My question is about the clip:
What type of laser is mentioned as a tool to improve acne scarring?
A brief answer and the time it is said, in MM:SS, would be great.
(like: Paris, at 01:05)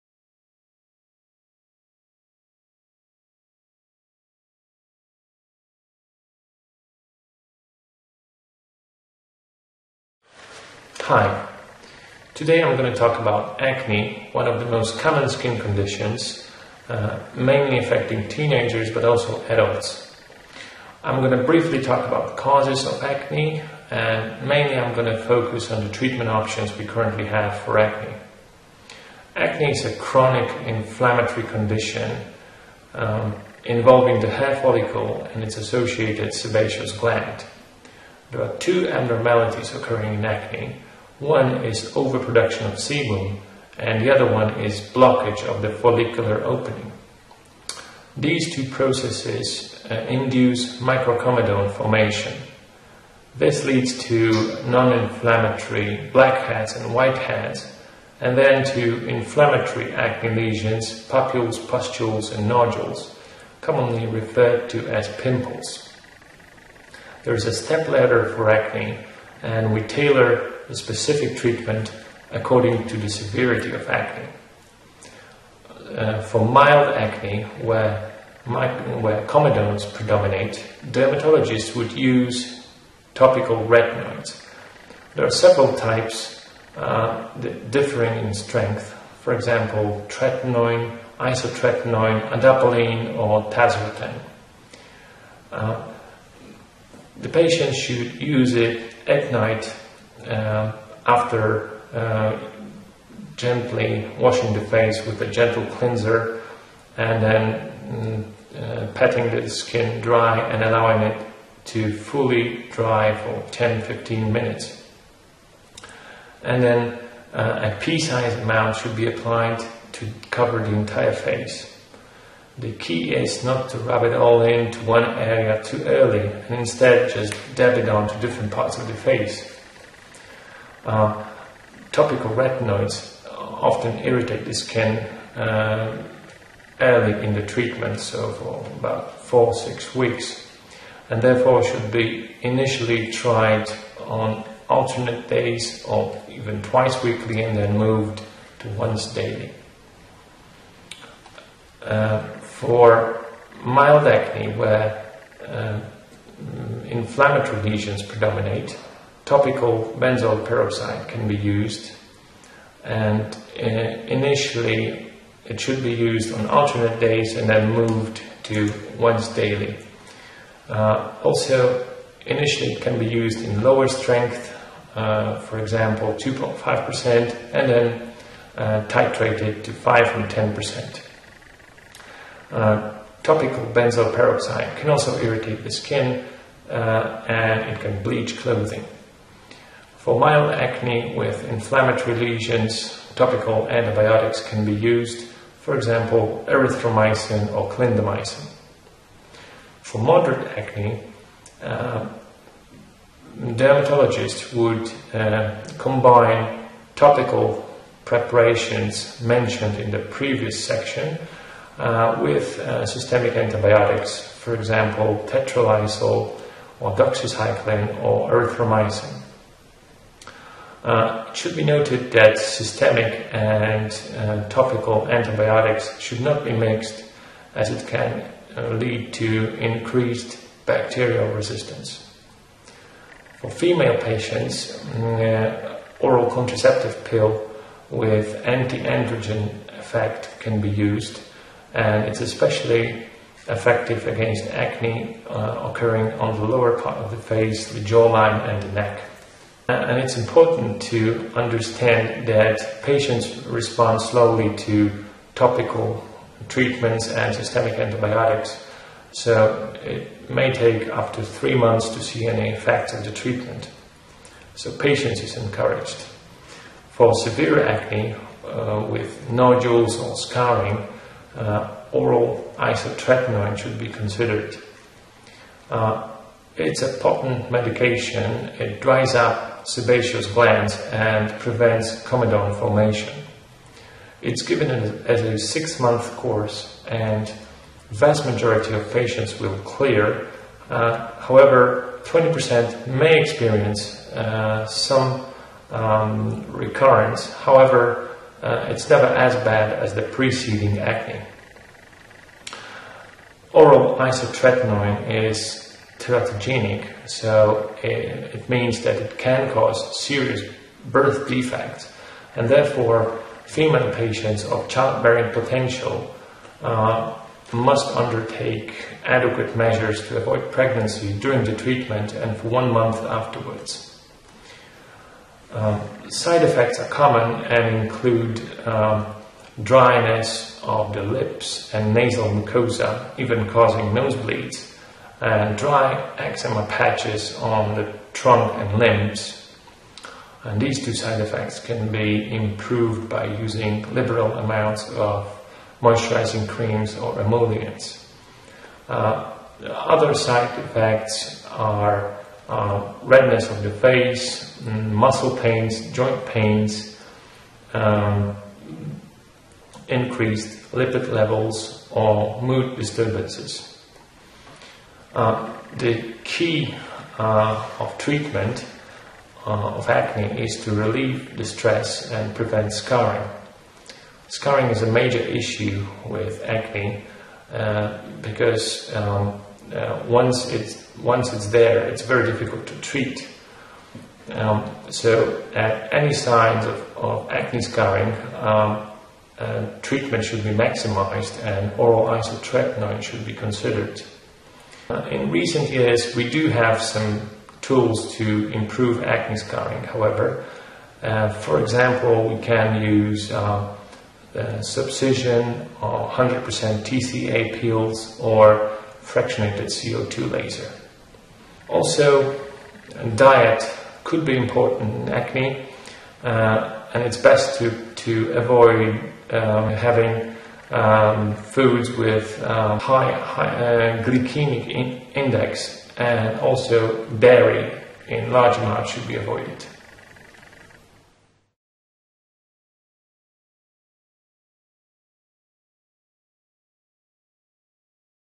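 fractionated CO2 laser, at 06:49.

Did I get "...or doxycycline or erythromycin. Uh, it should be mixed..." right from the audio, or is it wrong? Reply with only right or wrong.
wrong.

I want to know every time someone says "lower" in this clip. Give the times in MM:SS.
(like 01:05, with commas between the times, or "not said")
02:53, 04:06.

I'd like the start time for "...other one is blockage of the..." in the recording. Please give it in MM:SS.
00:44.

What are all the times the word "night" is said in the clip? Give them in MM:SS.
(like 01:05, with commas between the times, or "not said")
01:39.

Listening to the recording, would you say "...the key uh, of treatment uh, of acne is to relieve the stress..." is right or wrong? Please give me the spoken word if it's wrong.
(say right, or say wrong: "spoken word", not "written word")
right.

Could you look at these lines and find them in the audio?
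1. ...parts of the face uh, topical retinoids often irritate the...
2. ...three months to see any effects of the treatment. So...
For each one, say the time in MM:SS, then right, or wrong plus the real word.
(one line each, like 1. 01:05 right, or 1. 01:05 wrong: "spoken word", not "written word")
1. 02:08 right
2. 04:21 right.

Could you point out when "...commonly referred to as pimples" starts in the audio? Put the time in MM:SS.
01:03.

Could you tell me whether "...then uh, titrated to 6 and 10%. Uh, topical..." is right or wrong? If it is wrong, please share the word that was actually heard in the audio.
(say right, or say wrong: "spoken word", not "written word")
wrong: "5", not "6".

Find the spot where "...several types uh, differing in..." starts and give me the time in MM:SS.
01:25.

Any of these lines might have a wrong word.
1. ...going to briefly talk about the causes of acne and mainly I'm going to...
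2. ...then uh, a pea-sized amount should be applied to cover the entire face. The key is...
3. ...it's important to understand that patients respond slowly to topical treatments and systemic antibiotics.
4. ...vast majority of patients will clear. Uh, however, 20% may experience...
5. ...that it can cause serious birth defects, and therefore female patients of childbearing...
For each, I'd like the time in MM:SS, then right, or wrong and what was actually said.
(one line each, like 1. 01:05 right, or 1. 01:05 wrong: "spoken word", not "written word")
1. 00:21 right
2. 01:56 right
3. 04:09 right
4. 04:47 right
5. 05:08 right.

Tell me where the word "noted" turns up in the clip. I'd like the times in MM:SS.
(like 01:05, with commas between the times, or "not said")
03:41.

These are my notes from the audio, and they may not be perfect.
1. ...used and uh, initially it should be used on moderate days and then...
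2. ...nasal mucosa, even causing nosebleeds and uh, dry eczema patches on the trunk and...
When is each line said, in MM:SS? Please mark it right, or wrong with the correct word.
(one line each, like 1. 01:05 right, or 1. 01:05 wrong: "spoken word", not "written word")
1. 02:41 wrong: "alternate", not "moderate"
2. 05:31 right.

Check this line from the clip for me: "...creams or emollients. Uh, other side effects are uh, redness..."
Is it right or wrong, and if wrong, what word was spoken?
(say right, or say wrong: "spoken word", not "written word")
right.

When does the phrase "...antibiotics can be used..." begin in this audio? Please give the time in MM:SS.
03:13.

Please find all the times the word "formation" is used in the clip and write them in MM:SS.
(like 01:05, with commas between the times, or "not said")
00:51, 04:42.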